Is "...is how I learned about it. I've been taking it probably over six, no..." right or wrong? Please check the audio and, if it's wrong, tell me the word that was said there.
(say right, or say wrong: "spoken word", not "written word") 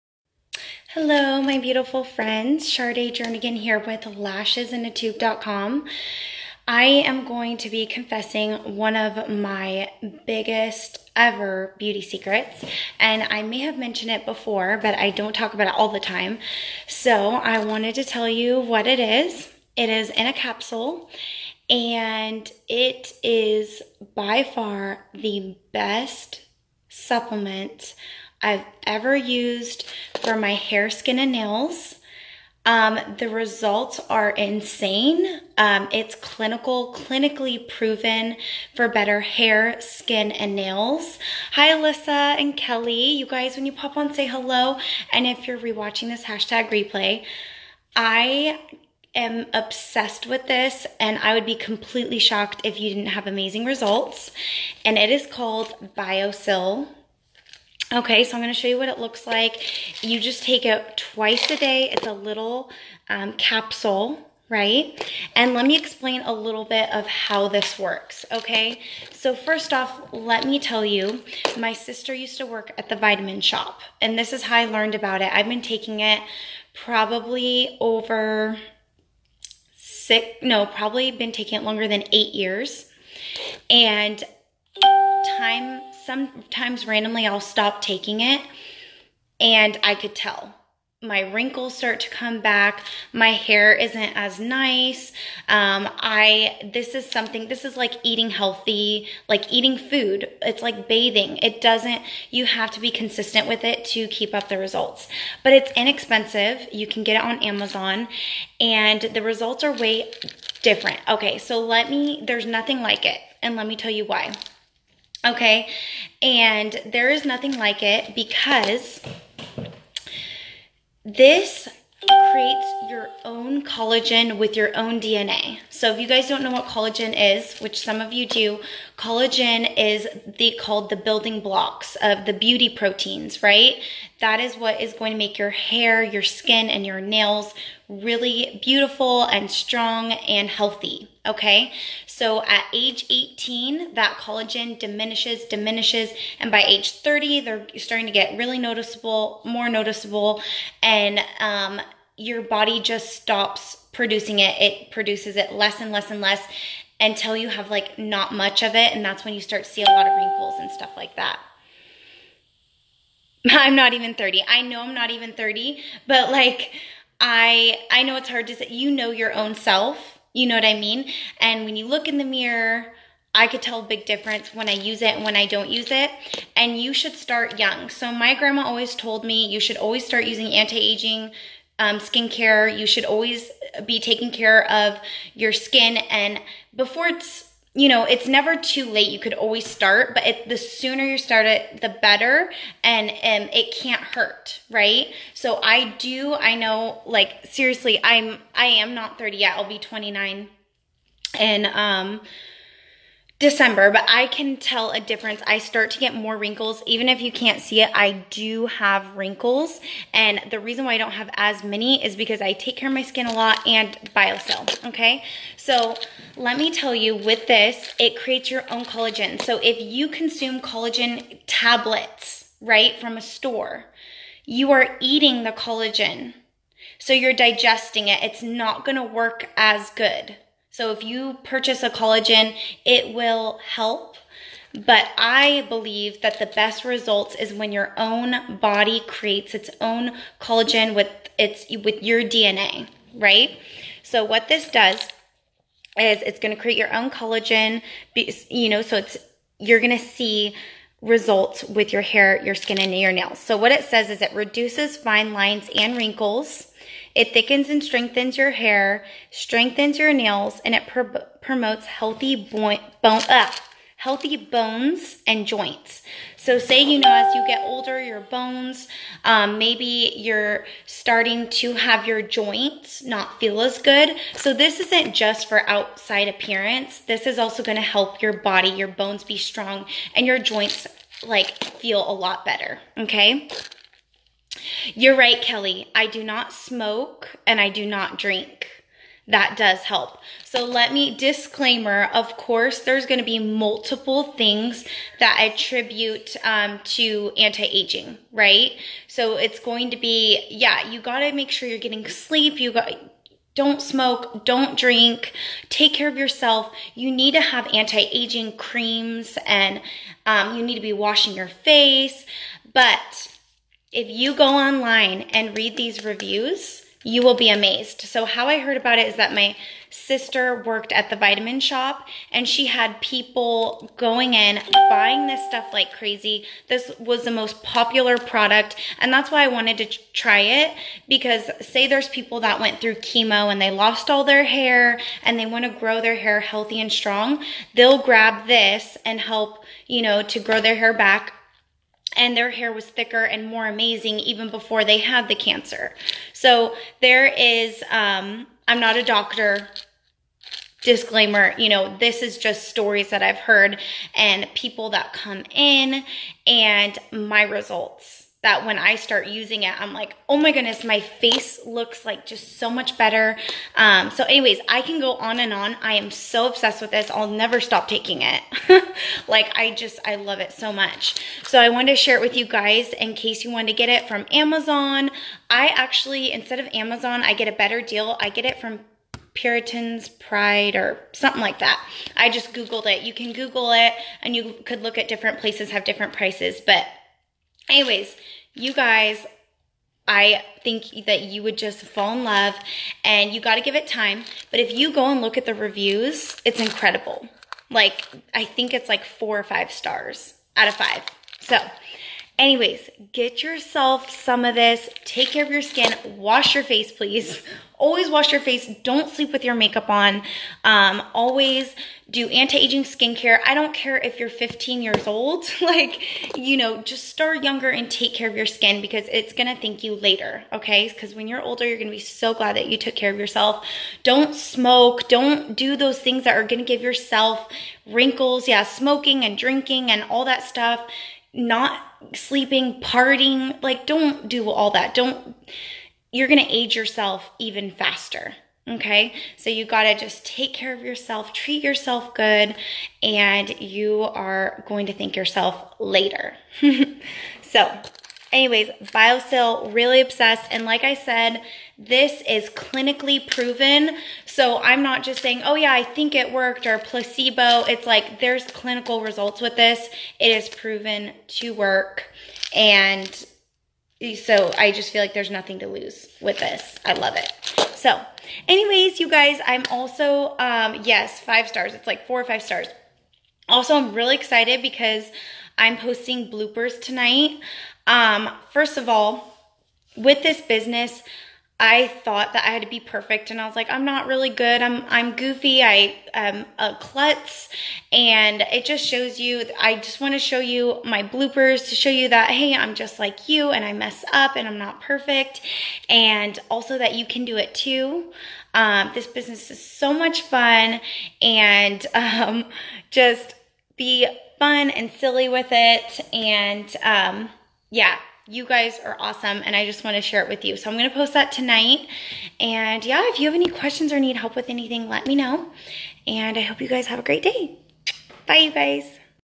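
right.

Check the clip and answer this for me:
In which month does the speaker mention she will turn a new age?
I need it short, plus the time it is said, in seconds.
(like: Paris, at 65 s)
December, at 203 s.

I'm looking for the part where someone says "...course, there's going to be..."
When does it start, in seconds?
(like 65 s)
292 s.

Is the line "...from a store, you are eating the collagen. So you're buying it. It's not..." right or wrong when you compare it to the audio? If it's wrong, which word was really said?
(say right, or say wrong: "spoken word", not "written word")
wrong: "digesting", not "buying".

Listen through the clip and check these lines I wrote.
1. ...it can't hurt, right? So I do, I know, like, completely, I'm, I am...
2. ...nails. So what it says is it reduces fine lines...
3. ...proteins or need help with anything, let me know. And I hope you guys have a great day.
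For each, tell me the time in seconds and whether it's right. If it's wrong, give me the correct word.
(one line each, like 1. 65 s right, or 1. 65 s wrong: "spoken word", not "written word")
1. 193 s wrong: "seriously", not "completely"
2. 253 s right
3. 513 s wrong: "questions", not "proteins".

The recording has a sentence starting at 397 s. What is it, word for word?
Like, I think it's like four or five stars out of five.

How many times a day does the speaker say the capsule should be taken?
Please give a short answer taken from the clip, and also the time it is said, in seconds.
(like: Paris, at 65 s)
twice, at 61 s.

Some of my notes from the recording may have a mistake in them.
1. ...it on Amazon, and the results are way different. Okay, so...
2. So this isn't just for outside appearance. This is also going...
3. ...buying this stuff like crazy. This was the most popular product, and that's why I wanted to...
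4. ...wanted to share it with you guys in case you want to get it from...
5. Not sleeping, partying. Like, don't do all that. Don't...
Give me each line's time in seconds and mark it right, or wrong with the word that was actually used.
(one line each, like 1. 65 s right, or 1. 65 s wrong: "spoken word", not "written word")
1. 107 s right
2. 274 s right
3. 324 s right
4. 371 s right
5. 431 s right.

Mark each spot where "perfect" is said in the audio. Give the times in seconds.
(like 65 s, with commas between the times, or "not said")
482 s, 494 s.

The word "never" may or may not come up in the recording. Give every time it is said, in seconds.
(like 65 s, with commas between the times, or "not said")
188 s, 367 s.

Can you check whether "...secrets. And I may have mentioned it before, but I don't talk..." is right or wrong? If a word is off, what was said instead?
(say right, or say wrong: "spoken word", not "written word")
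right.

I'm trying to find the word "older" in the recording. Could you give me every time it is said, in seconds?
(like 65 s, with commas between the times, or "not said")
267 s, 421 s.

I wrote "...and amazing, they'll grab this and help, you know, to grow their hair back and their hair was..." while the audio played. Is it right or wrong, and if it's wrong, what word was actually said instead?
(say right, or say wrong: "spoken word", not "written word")
wrong: "strong", not "amazing".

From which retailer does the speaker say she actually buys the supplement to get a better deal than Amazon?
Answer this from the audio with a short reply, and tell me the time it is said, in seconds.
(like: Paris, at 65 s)
Puritan's Pride, at 379 s.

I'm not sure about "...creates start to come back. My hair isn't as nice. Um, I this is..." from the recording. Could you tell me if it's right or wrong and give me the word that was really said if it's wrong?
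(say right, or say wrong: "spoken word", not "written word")
wrong: "wrinkles", not "creates".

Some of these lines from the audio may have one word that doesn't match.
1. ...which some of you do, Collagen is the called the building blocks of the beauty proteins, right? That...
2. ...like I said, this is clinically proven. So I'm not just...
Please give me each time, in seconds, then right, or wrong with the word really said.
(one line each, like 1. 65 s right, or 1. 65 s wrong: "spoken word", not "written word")
1. 127 s right
2. 450 s right.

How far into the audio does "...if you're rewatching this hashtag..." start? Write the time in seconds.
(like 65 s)
45 s.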